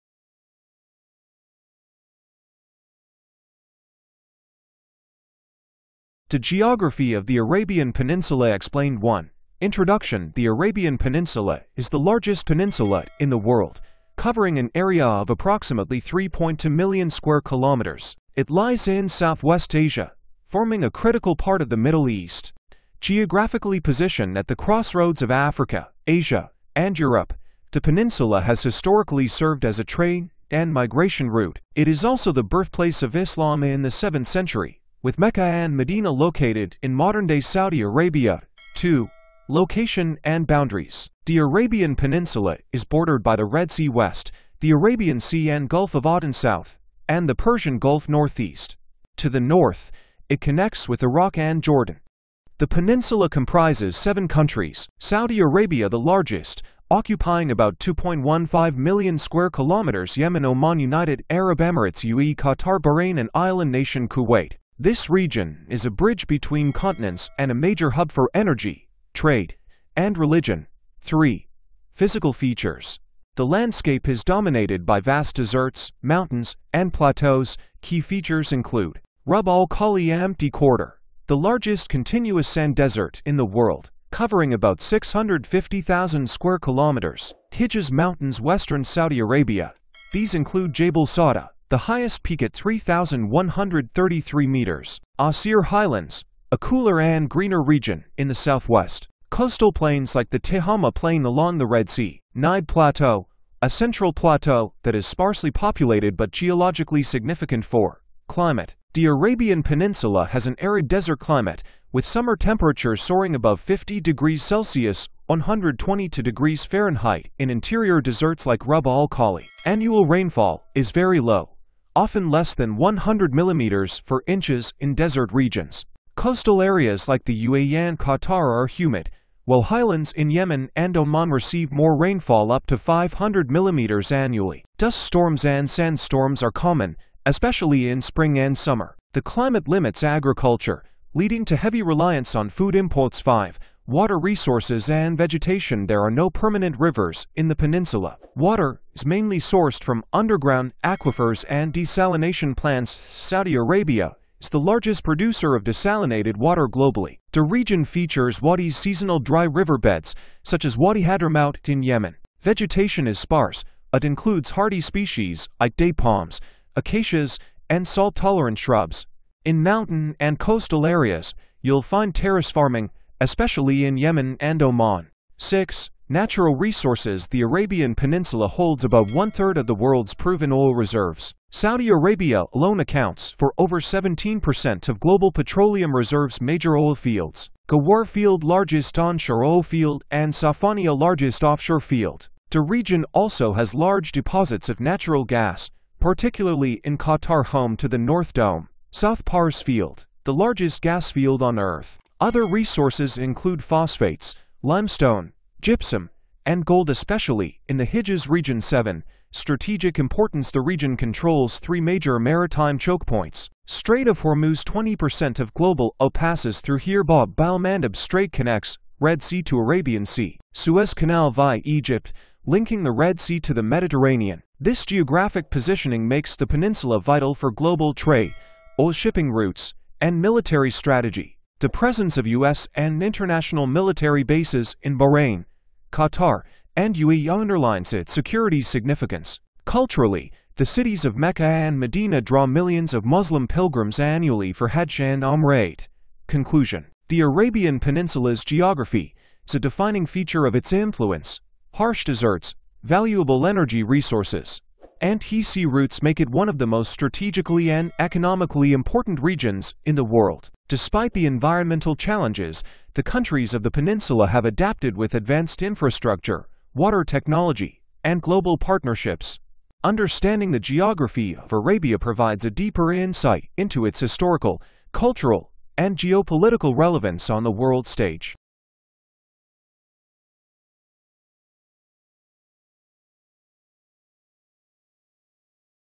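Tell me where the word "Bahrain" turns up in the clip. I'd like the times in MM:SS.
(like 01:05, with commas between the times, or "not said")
01:02, 03:54.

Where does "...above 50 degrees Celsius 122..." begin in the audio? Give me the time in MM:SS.
01:53.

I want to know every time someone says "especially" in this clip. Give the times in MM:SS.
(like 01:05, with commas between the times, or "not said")
02:17, 02:53, 03:26.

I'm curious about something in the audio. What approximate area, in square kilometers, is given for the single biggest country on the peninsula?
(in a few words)
2.15 million.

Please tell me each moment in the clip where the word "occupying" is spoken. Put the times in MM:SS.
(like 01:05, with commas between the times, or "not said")
00:56.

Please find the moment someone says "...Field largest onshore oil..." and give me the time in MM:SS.
03:08.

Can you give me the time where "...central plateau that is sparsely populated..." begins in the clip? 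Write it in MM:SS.
01:43.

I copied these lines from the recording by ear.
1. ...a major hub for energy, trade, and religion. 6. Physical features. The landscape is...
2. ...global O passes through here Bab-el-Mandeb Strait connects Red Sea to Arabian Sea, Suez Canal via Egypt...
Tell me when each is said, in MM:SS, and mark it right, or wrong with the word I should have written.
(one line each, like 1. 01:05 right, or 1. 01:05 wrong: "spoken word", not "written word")
1. 01:07 wrong: "3", not "6"
2. 03:35 right.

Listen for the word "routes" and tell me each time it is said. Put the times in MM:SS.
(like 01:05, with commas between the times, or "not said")
00:31, 03:49, 04:15.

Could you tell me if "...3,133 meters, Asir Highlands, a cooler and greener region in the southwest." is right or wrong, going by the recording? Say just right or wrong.
right.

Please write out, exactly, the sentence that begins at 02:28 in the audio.
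Water is mainly sourced from underground aquifers and desalination plants.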